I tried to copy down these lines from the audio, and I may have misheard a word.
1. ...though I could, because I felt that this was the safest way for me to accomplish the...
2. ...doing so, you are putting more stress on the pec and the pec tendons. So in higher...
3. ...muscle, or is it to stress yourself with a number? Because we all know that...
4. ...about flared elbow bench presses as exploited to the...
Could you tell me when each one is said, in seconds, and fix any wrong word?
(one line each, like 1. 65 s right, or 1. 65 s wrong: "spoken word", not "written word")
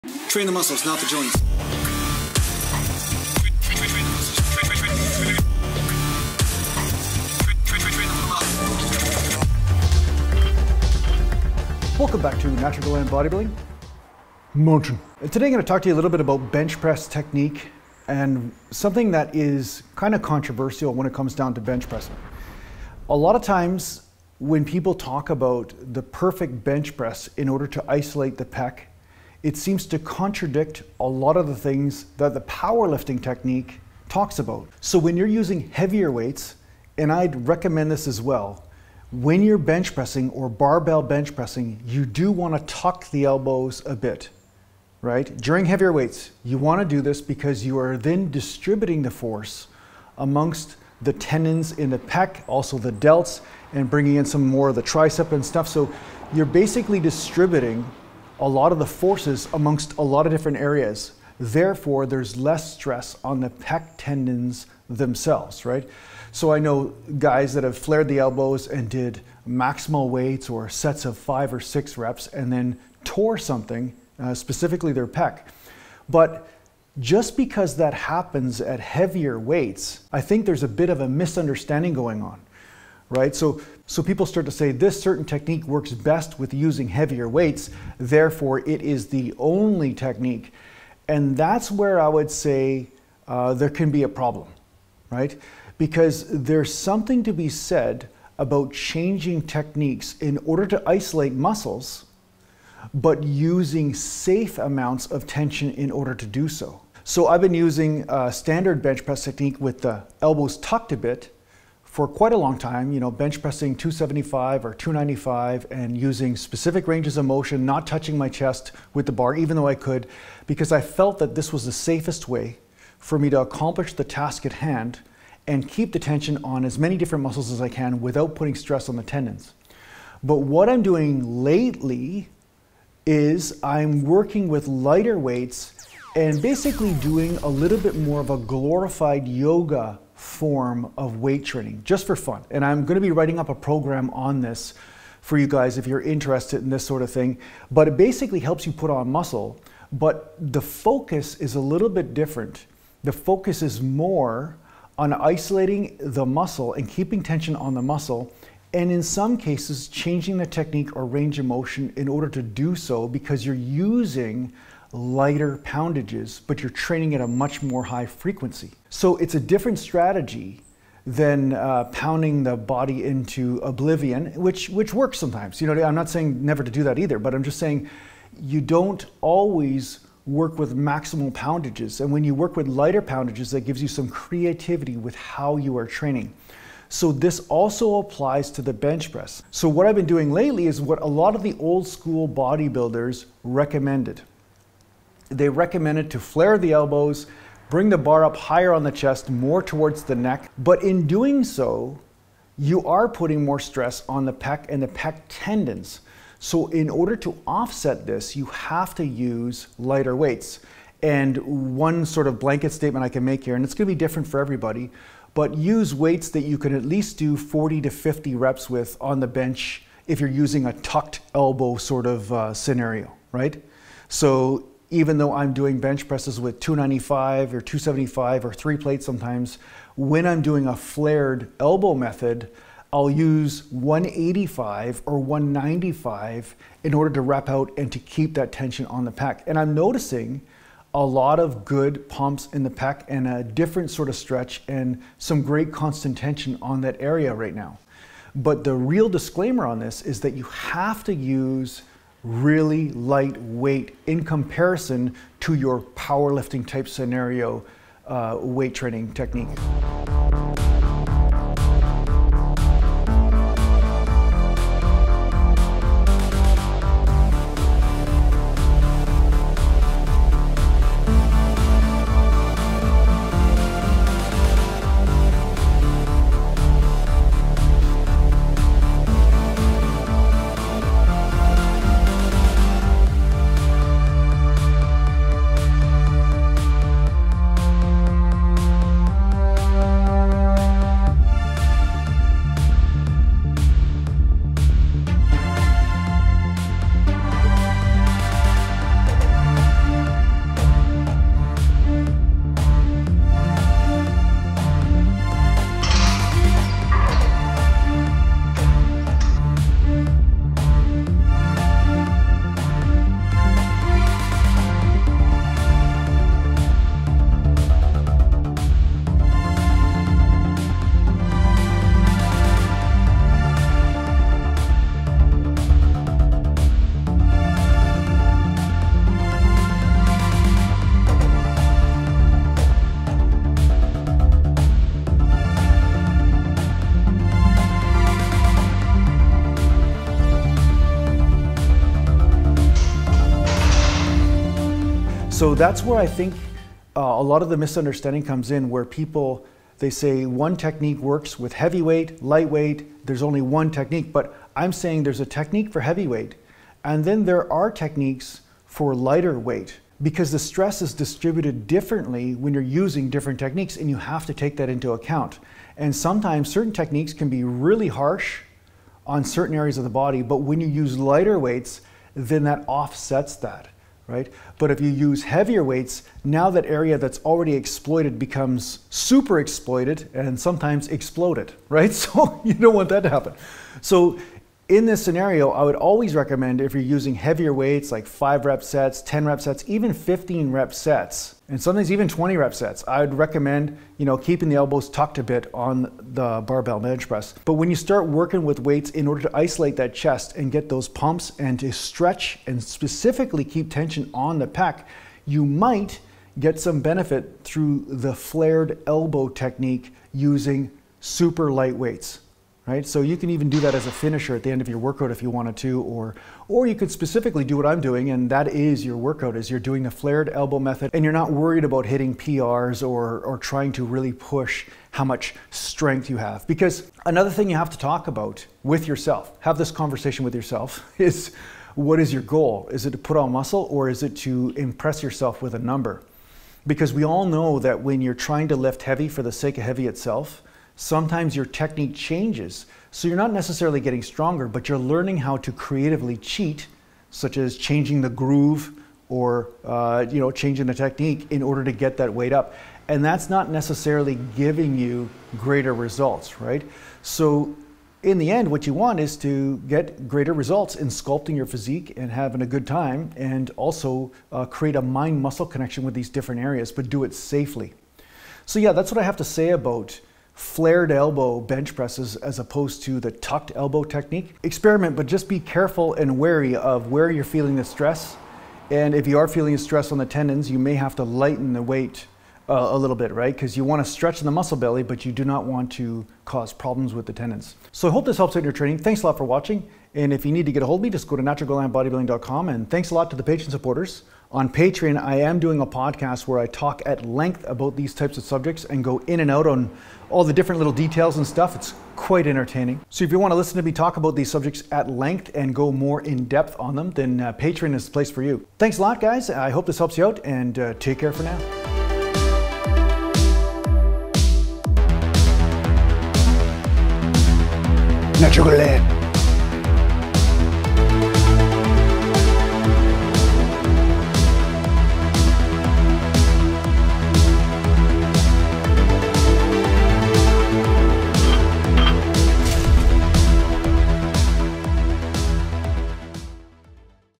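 1. 119 s right
2. 201 s wrong: "order", not "higher"
3. 433 s wrong: "impress", not "stress"
4. 469 s wrong: "opposed", not "exploited".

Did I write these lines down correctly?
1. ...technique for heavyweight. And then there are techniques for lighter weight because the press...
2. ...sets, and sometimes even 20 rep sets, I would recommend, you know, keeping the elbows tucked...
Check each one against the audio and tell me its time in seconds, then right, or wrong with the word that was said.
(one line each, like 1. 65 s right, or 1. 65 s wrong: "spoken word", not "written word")
1. 355 s wrong: "stress", not "press"
2. 390 s right.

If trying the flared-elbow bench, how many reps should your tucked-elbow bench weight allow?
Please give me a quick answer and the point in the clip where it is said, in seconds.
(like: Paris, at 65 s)
40 to 50, at 217 s.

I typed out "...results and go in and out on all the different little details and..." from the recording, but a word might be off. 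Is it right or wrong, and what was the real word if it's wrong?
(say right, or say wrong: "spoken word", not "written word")
wrong: "subjects", not "results".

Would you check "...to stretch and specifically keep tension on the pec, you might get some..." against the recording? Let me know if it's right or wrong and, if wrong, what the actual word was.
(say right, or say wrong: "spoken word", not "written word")
right.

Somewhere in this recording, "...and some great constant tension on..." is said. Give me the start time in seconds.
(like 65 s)
244 s.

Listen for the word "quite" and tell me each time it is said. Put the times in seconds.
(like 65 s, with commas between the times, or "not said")
112 s, 501 s.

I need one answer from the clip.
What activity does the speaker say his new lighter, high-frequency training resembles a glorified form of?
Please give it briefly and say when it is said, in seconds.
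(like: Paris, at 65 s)
Yoga, at 139 s.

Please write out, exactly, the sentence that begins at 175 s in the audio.
You know, I'm not saying never to do that either, but I'm just saying you don't always work with maximal poundages.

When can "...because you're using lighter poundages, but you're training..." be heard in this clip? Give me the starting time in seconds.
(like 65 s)
163 s.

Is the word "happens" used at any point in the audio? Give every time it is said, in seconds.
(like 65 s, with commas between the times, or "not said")
77 s, 383 s.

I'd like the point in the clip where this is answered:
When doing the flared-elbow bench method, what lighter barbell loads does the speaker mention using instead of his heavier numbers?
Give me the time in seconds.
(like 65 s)
233 s.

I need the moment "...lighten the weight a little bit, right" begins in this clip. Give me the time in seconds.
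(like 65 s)
481 s.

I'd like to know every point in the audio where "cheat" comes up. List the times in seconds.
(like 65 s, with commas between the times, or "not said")
446 s.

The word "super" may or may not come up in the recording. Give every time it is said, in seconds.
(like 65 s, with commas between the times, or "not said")
378 s, 411 s.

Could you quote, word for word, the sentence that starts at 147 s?
But it basically helps you put on muscle, but the focus is a little bit different.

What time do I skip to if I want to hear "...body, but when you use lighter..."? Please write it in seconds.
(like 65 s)
369 s.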